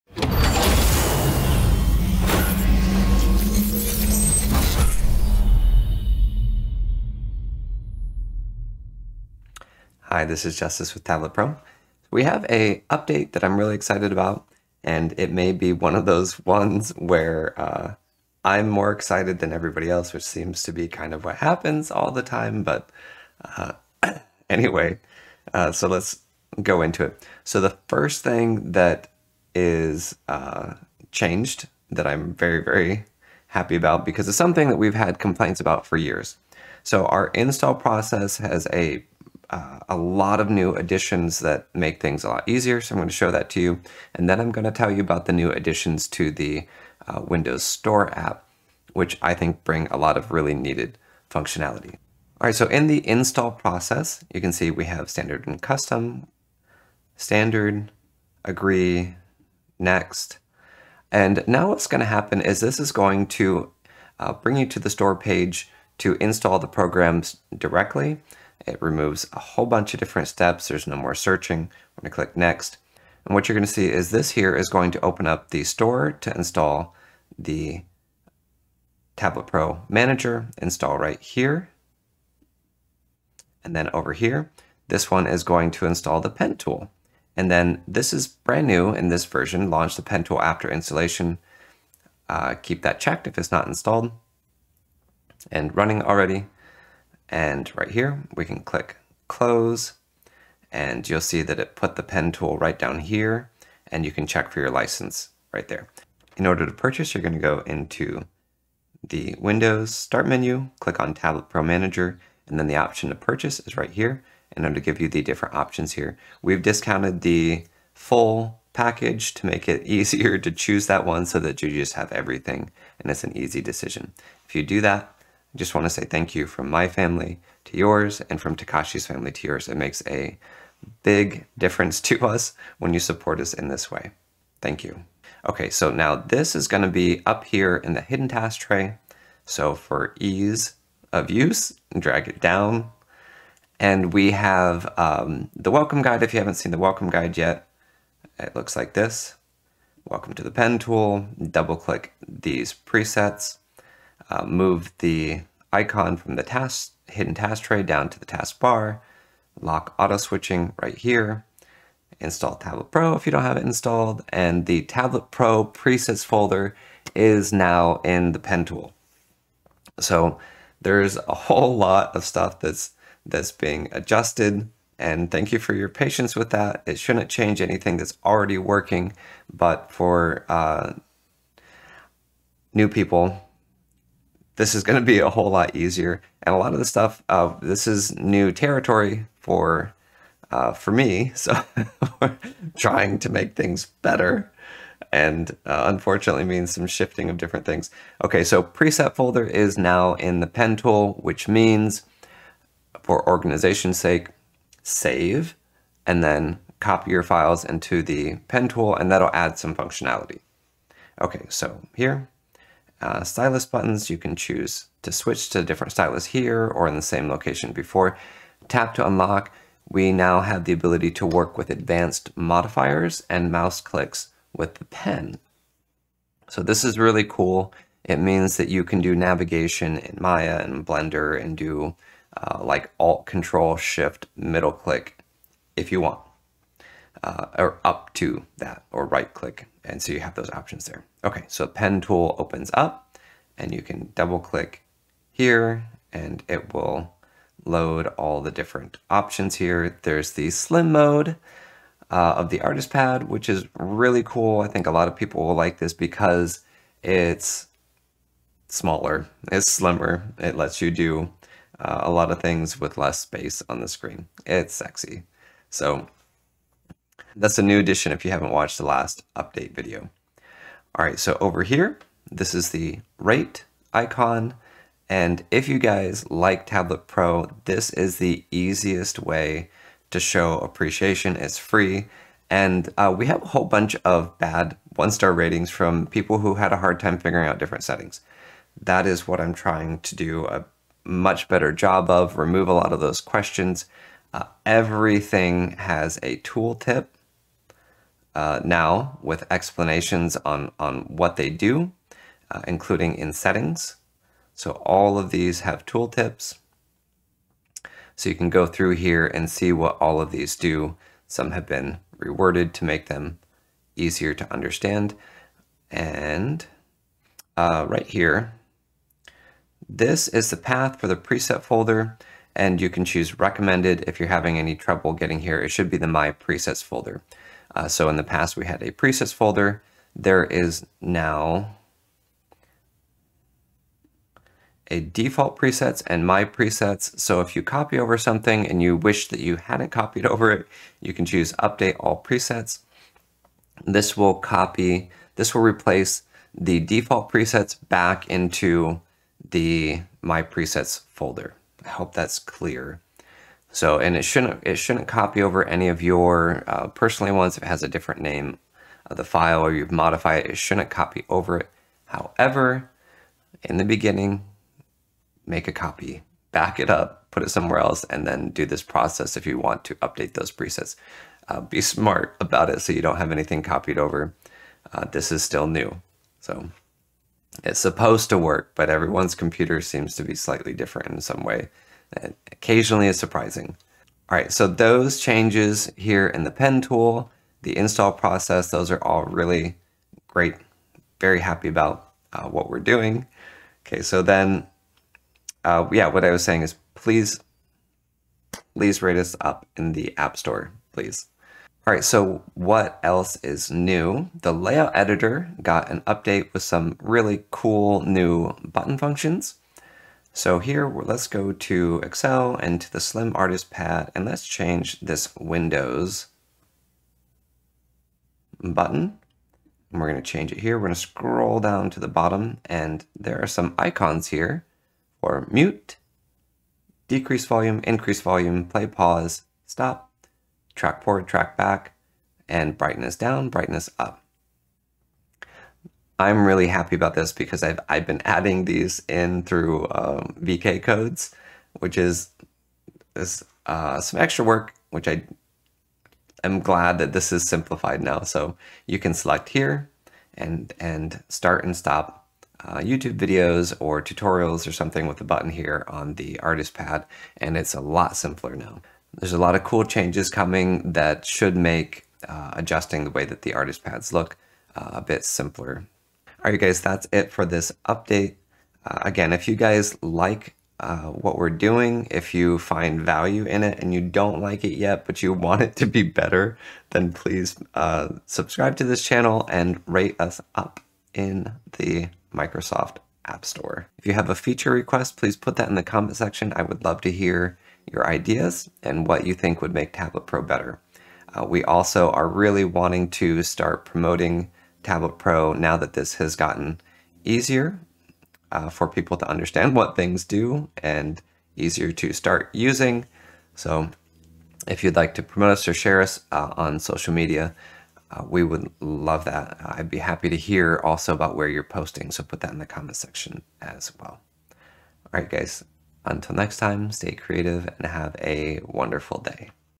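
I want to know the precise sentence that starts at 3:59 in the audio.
And so you have those options there.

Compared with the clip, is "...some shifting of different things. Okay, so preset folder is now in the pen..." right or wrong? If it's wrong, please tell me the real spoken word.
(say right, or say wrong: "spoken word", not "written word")
right.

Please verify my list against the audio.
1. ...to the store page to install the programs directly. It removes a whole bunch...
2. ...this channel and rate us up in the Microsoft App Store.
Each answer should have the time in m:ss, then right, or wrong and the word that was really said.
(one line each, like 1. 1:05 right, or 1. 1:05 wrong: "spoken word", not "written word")
1. 1:04 right
2. 7:58 right.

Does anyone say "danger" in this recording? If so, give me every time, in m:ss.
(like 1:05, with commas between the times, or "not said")
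not said.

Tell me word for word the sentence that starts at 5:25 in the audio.
It should be the My Presets folder.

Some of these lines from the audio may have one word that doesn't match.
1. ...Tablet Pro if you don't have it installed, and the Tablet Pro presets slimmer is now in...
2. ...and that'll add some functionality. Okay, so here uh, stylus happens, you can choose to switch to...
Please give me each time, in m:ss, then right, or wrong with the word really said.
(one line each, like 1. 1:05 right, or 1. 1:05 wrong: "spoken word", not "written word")
1. 2:42 wrong: "folder", not "slimmer"
2. 3:28 wrong: "buttons", not "happens".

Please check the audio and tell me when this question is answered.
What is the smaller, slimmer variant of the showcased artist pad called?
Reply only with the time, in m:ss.
4:10.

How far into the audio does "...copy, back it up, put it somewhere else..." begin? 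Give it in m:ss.
6:05.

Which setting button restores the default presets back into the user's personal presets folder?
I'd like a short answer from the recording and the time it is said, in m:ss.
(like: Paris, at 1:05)
Update all presets, at 5:41.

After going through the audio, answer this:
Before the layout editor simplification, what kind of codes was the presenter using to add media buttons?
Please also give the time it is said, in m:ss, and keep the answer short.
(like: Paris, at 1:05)
VK codes, at 7:20.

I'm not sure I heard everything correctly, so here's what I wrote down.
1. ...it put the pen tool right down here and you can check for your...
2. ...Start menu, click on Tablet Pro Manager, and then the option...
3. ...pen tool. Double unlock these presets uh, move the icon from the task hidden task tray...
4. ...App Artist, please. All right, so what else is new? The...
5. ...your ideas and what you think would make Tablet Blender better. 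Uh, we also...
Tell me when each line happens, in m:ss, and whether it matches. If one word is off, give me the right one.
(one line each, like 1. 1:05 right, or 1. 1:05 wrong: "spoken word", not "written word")
1. 1:41 right
2. 1:49 right
3. 2:30 wrong: "click", not "unlock"
4. 6:40 wrong: "Store", not "Artist"
5. 8:07 wrong: "Pro", not "Blender".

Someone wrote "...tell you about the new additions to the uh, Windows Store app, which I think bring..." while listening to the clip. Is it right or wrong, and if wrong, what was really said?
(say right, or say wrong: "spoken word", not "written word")
right.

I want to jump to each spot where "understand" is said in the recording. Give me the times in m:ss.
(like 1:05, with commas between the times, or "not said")
5:14, 8:19.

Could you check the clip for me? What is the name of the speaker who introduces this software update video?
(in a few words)
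Justice.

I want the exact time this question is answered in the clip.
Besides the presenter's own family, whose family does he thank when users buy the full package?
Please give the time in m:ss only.
2:08.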